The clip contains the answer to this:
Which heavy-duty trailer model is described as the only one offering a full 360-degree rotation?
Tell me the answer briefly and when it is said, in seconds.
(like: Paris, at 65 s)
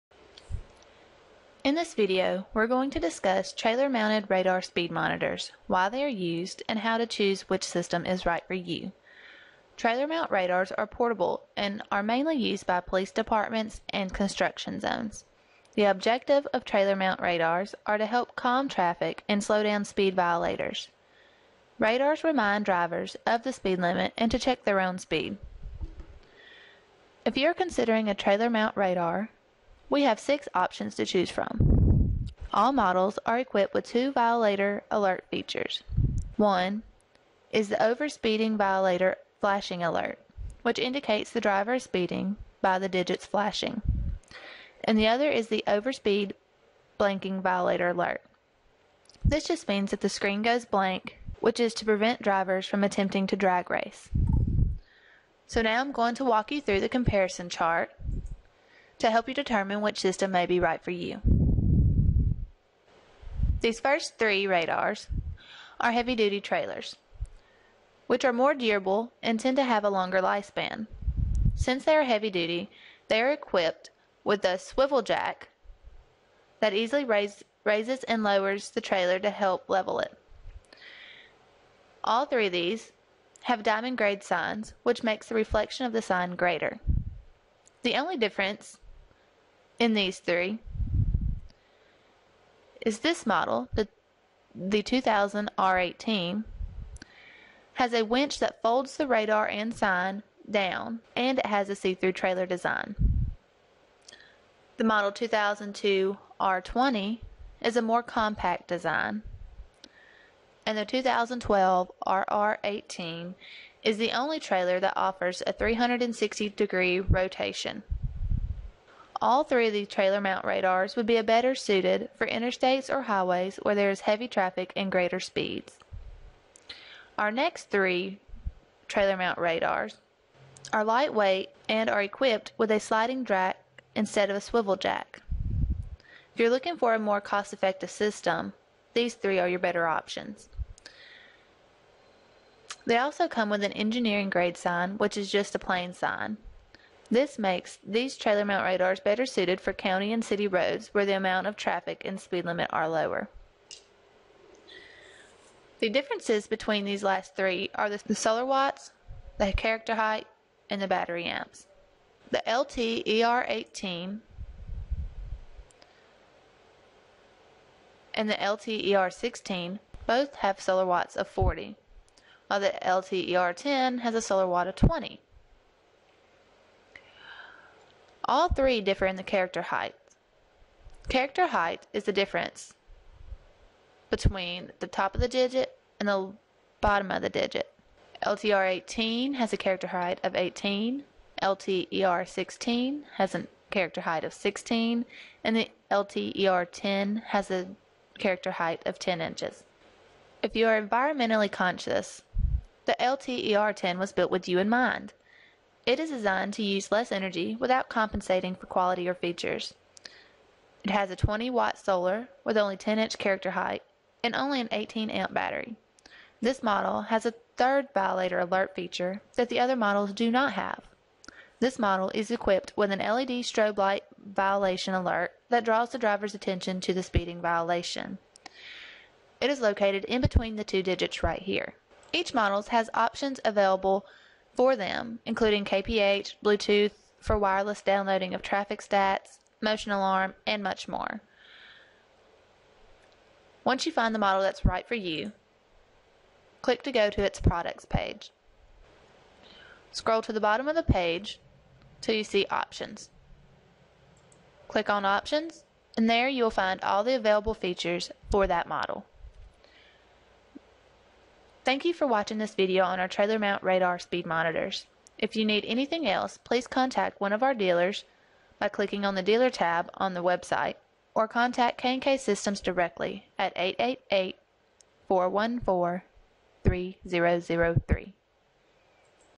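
2012 RR18, at 110 s.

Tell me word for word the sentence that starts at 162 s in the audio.
The LTER18 and the LTER16 both have solar watts of 40, while the LTER10 has a solar watt of 20.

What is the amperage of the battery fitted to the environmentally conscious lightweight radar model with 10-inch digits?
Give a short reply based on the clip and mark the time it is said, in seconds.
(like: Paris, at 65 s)
18 amp, at 214 s.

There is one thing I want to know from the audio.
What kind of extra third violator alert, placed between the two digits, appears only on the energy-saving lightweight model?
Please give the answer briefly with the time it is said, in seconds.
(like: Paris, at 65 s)
LED strobe light, at 222 s.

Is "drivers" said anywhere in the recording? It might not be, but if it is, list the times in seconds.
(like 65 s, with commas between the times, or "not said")
22 s, 41 s, 52 s, 225 s.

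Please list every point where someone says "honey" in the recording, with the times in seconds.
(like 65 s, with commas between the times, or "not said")
not said.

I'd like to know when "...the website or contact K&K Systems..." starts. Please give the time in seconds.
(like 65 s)
270 s.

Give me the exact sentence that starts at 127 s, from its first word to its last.
Our next three trailer mount radars are lightweight and are equipped with a sliding jack instead of a swivel jack.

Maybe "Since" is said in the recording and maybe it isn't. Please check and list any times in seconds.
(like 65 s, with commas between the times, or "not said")
71 s.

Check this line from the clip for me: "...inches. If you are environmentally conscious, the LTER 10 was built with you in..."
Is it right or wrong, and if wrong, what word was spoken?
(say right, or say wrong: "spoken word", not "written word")
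right.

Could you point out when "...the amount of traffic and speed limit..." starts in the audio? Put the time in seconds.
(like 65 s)
151 s.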